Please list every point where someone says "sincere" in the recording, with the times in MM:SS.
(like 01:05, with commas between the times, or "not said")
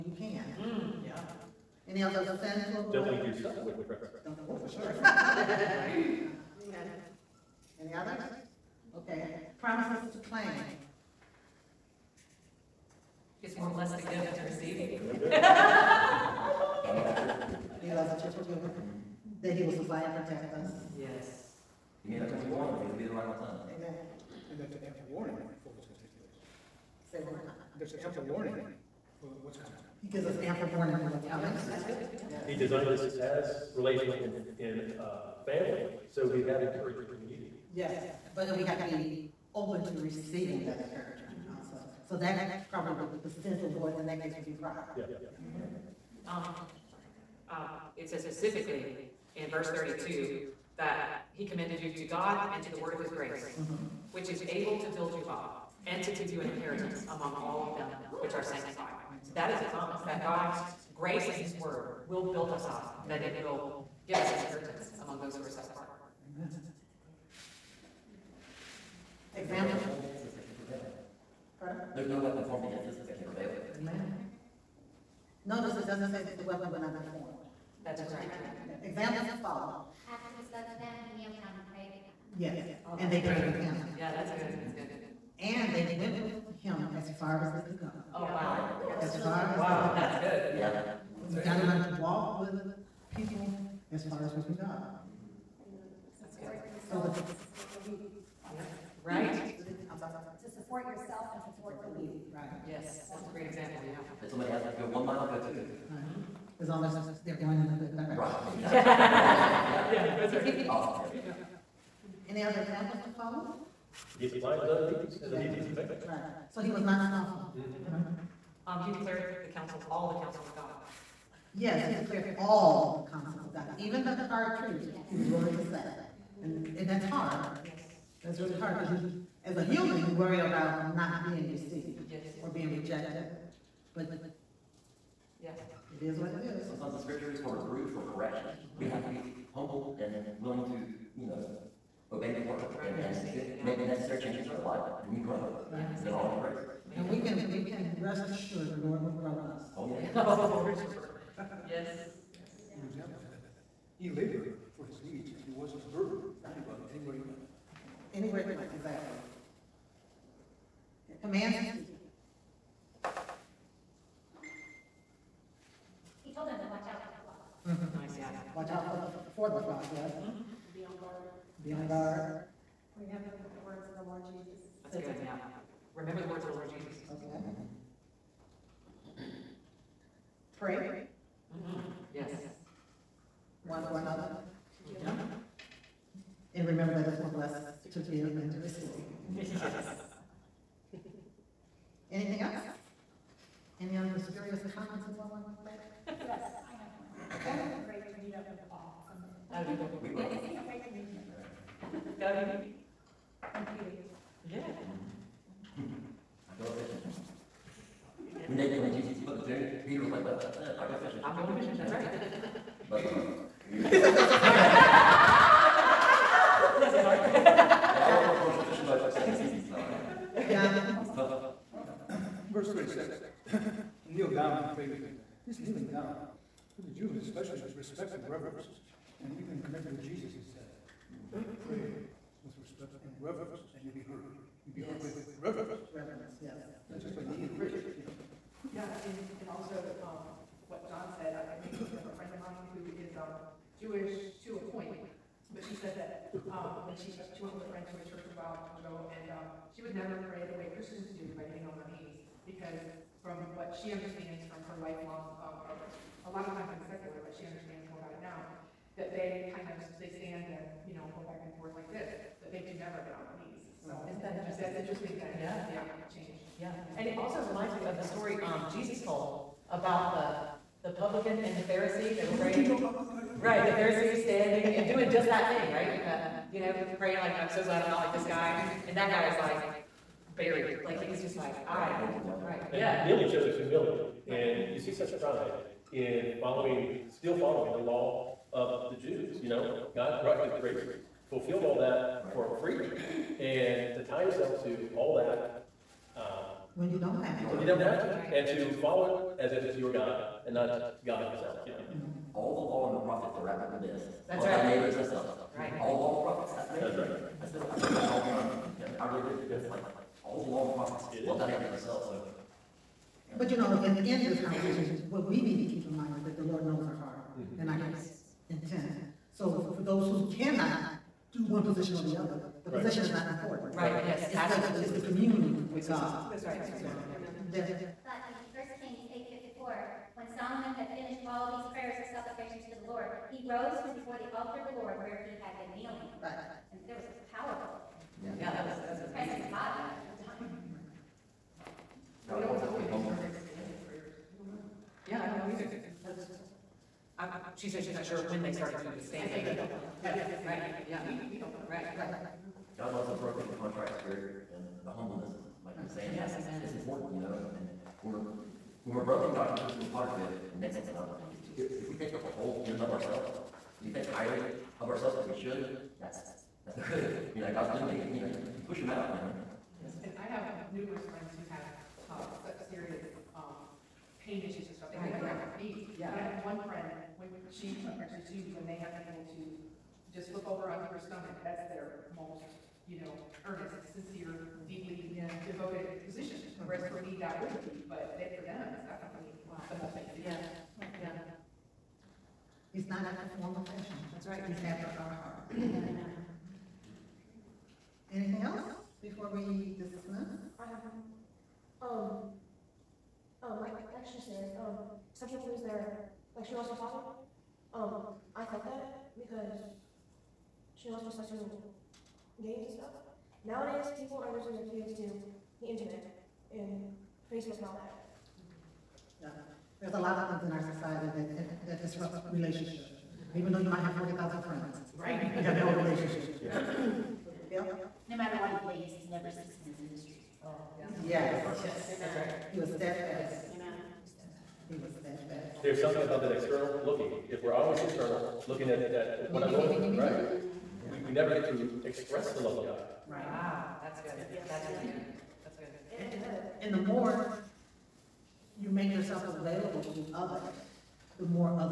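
06:23.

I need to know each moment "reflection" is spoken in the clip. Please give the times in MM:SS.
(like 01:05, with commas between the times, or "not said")
not said.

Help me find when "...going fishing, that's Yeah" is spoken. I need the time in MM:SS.
03:31.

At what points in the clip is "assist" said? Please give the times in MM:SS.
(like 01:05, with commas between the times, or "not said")
not said.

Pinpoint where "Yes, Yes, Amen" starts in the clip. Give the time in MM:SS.
07:11.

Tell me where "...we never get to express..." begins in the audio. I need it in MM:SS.
07:21.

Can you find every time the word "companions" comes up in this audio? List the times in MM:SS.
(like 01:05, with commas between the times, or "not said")
01:55.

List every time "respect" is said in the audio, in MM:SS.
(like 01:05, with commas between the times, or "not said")
03:47, 03:52.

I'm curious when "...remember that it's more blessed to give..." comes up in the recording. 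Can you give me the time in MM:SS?
03:06.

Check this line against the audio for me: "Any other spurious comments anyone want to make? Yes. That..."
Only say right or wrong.
right.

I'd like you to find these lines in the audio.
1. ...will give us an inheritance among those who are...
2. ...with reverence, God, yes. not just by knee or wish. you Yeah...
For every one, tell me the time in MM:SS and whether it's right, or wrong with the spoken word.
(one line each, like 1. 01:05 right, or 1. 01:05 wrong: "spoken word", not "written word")
1. 01:03 right
2. 03:55 wrong: "Reverence", not "God".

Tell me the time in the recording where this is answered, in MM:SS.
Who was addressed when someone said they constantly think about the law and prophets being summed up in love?
05:08.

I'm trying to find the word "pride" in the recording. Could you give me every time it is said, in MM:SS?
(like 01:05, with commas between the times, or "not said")
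00:44, 04:45.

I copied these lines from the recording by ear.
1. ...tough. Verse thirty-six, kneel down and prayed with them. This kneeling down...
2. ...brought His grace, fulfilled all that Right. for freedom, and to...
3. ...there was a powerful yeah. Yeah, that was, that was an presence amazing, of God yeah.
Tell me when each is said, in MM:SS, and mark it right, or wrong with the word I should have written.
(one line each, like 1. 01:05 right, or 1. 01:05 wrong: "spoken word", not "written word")
1. 03:41 right
2. 04:50 right
3. 05:36 right.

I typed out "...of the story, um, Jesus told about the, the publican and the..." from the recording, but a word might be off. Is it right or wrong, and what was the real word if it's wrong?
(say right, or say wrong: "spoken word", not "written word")
right.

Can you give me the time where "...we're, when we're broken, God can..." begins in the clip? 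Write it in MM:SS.
05:58.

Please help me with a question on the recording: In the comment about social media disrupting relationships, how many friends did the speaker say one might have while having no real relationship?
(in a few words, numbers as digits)
40,000.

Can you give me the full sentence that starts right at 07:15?
There's something about that external looking.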